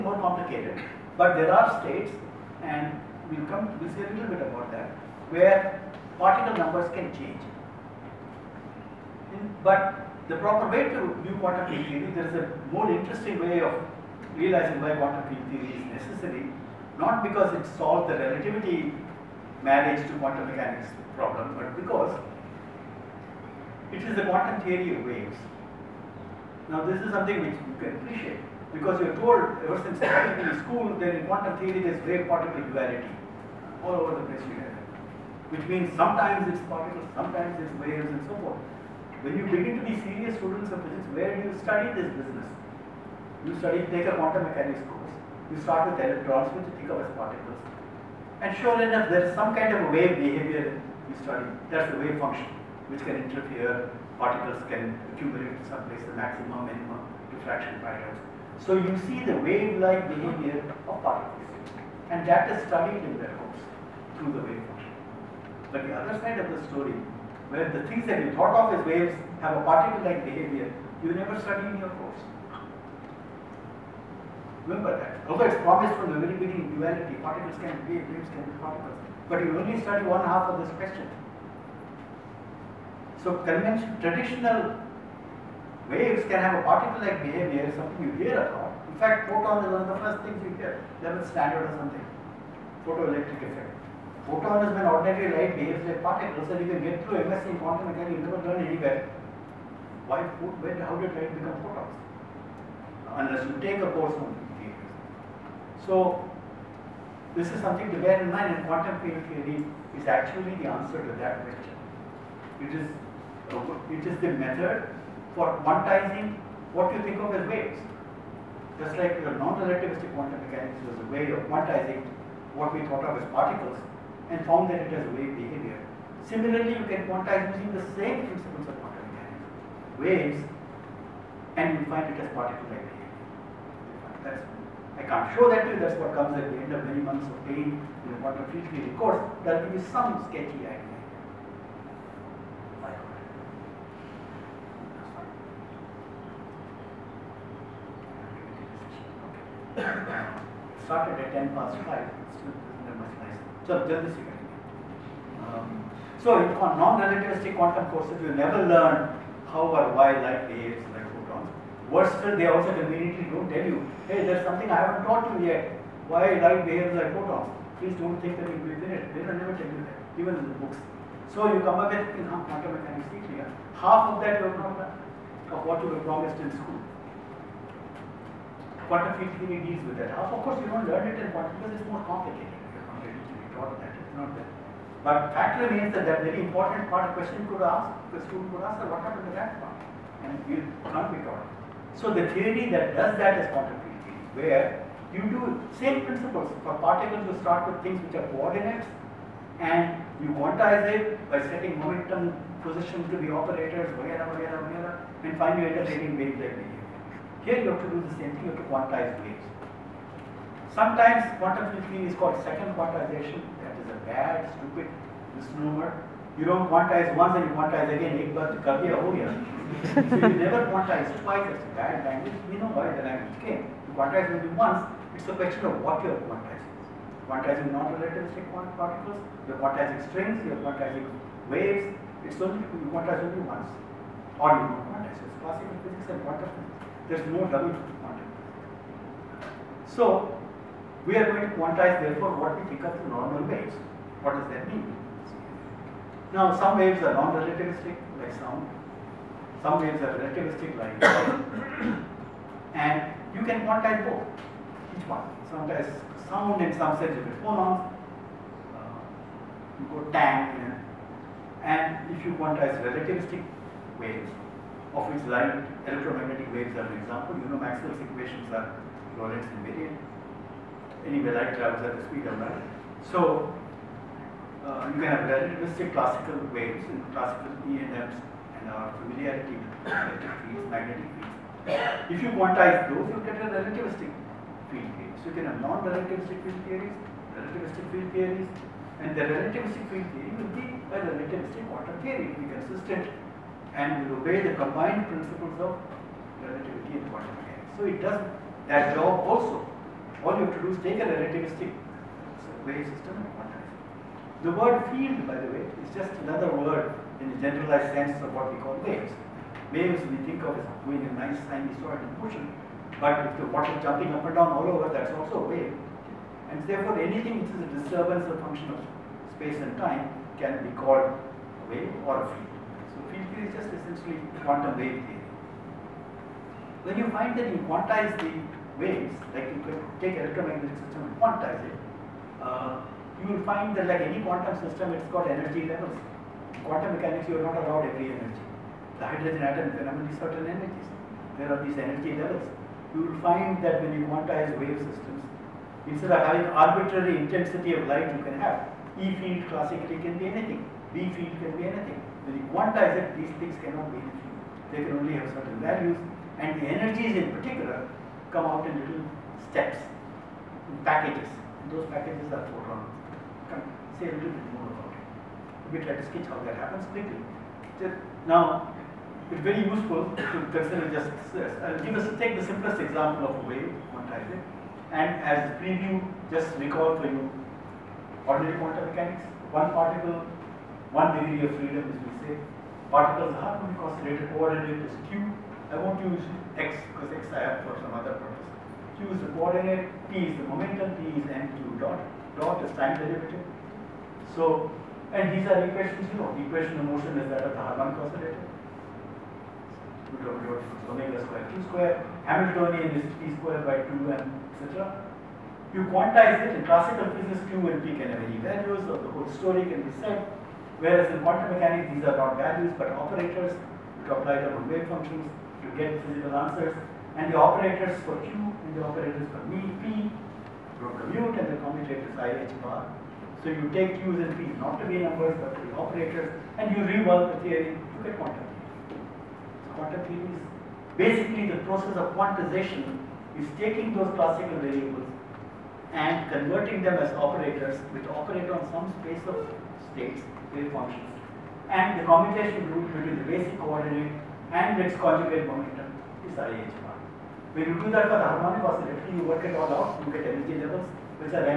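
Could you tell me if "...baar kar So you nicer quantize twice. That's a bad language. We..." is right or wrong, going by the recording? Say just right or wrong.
wrong.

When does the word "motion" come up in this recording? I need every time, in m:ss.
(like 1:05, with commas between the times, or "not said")
5:12, 6:36.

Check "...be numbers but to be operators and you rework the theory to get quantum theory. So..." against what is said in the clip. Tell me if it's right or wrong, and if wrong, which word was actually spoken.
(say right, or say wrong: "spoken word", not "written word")
right.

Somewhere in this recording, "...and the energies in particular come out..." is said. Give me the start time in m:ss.
5:56.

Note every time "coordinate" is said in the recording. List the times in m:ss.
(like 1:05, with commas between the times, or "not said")
3:18, 6:24, 6:29, 7:23.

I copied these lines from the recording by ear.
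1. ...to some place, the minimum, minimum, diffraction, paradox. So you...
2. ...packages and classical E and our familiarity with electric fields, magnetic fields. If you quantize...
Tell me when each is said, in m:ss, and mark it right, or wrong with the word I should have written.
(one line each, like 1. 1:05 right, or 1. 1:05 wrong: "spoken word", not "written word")
1. 0:55 wrong: "maximum", not "minimum"
2. 4:36 wrong: "waves", not "packages".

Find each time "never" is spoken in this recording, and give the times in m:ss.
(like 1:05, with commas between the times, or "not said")
1:11, 1:38, 2:38, 2:49, 3:40.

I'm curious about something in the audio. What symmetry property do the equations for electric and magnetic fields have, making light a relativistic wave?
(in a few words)
Lorentz invariant.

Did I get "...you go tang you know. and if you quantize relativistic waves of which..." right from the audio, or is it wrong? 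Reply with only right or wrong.
right.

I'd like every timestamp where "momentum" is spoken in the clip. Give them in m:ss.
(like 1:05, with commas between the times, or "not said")
3:21, 6:30, 7:25.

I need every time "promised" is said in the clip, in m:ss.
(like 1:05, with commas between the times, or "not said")
1:15, 2:56.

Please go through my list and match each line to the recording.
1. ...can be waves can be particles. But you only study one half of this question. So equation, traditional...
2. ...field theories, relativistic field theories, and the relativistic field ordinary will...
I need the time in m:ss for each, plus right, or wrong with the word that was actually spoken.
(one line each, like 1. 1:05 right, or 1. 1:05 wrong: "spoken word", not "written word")
1. 1:17 wrong: "convention", not "equation"
2. 4:46 wrong: "theory", not "ordinary".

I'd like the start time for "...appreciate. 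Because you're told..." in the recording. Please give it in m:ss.
0:27.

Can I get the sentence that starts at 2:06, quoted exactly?
Similarly, you can quantize using the same principles of quantum mechanics, waves, and you find it as particle-like behavior.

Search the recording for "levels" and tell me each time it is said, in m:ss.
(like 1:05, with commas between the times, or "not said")
1:31, 3:57, 5:35, 5:42, 7:30.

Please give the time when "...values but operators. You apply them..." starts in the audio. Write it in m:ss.
6:52.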